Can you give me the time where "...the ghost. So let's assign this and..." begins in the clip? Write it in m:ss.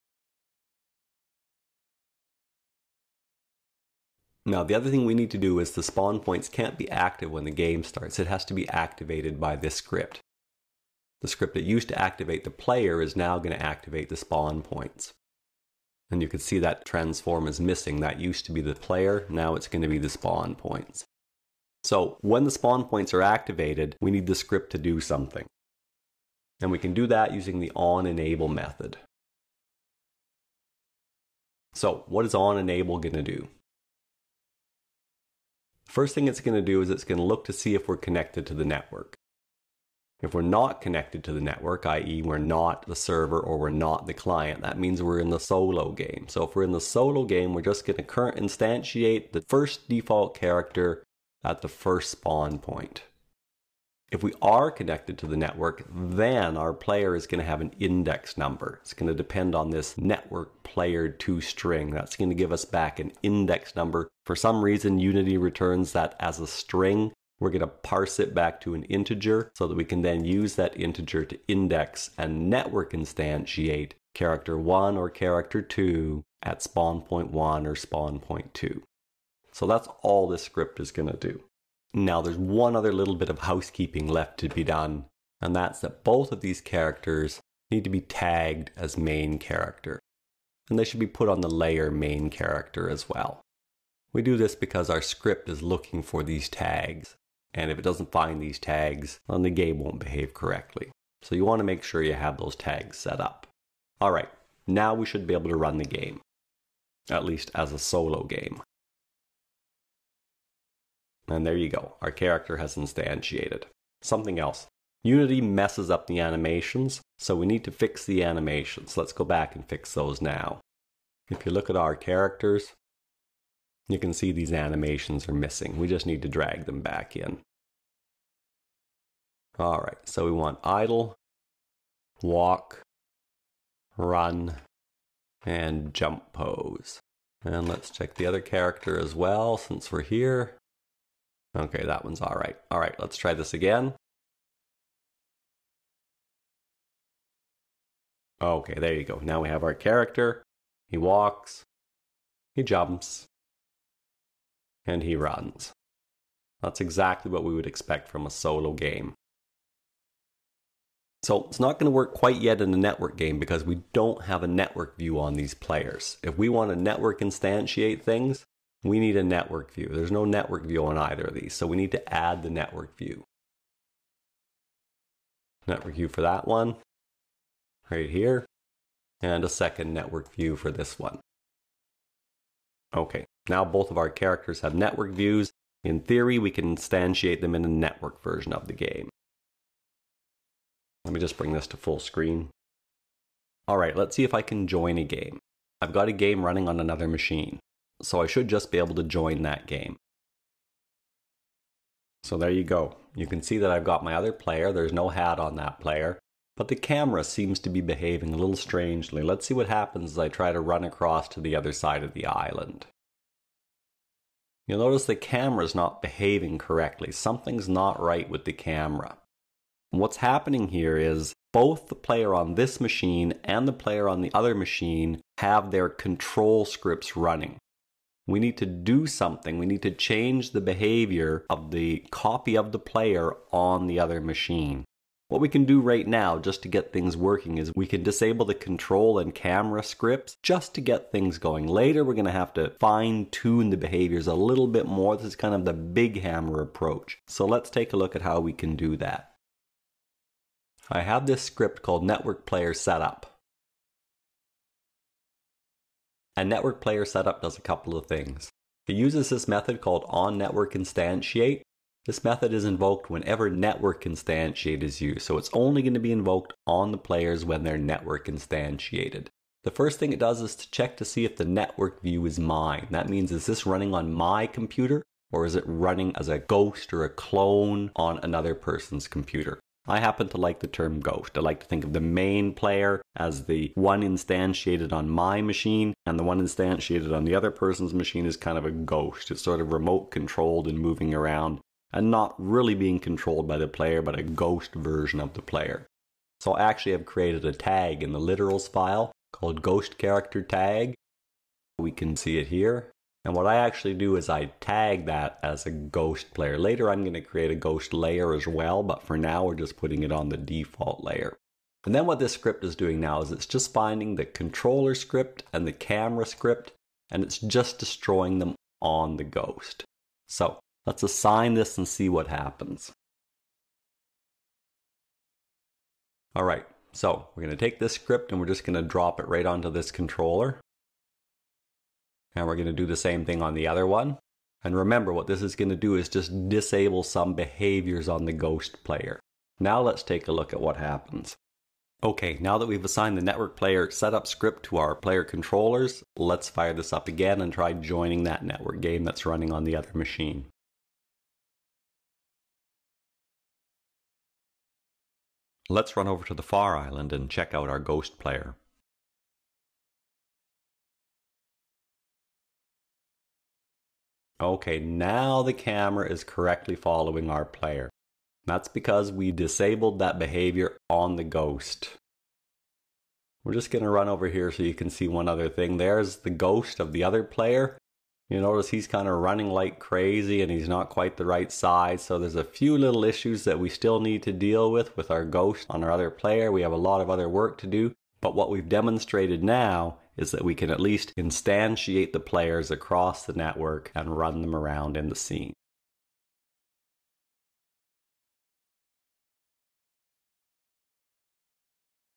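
5:19.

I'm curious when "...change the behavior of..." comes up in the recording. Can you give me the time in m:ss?
3:49.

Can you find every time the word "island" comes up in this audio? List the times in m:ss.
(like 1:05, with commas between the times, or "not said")
3:32, 5:56.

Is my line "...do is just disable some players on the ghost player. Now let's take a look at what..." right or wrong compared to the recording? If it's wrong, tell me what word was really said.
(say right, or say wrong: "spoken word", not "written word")
wrong: "behaviors", not "players".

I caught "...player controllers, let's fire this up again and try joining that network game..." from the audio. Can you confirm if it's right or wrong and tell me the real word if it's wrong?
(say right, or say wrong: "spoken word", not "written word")
right.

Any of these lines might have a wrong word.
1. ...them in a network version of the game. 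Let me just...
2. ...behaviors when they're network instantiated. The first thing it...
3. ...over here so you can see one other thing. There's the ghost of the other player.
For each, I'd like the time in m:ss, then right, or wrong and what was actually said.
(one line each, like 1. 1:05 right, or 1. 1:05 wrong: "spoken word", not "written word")
1. 3:07 right
2. 4:26 wrong: "players", not "behaviors"
3. 6:14 right.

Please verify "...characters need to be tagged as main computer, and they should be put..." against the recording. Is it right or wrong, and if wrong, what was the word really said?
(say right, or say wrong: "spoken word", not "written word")
wrong: "character", not "computer".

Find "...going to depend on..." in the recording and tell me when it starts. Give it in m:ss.
0:58.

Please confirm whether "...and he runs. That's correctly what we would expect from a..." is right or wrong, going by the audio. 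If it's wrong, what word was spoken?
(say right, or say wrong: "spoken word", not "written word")
wrong: "exactly", not "correctly".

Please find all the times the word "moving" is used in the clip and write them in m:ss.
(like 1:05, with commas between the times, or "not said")
4:50.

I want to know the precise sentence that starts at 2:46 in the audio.
If we want to network instantiate things, we need a network view.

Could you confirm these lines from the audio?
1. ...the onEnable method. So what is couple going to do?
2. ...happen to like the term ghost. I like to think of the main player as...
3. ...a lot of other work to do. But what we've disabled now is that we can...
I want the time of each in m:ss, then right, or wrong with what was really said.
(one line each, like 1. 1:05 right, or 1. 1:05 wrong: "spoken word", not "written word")
1. 0:27 wrong: "onEnable", not "couple"
2. 4:39 right
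3. 6:26 wrong: "demonstrated", not "disabled".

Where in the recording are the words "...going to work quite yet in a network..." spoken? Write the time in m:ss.
2:41.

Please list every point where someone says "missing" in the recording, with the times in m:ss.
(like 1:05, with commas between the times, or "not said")
0:17, 2:05.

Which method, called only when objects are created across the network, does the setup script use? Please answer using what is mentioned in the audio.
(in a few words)
onNetwork instantiate.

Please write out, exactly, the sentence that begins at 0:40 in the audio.
If we're not connected to the network, i.e.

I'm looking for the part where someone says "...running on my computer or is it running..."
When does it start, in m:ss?
4:33.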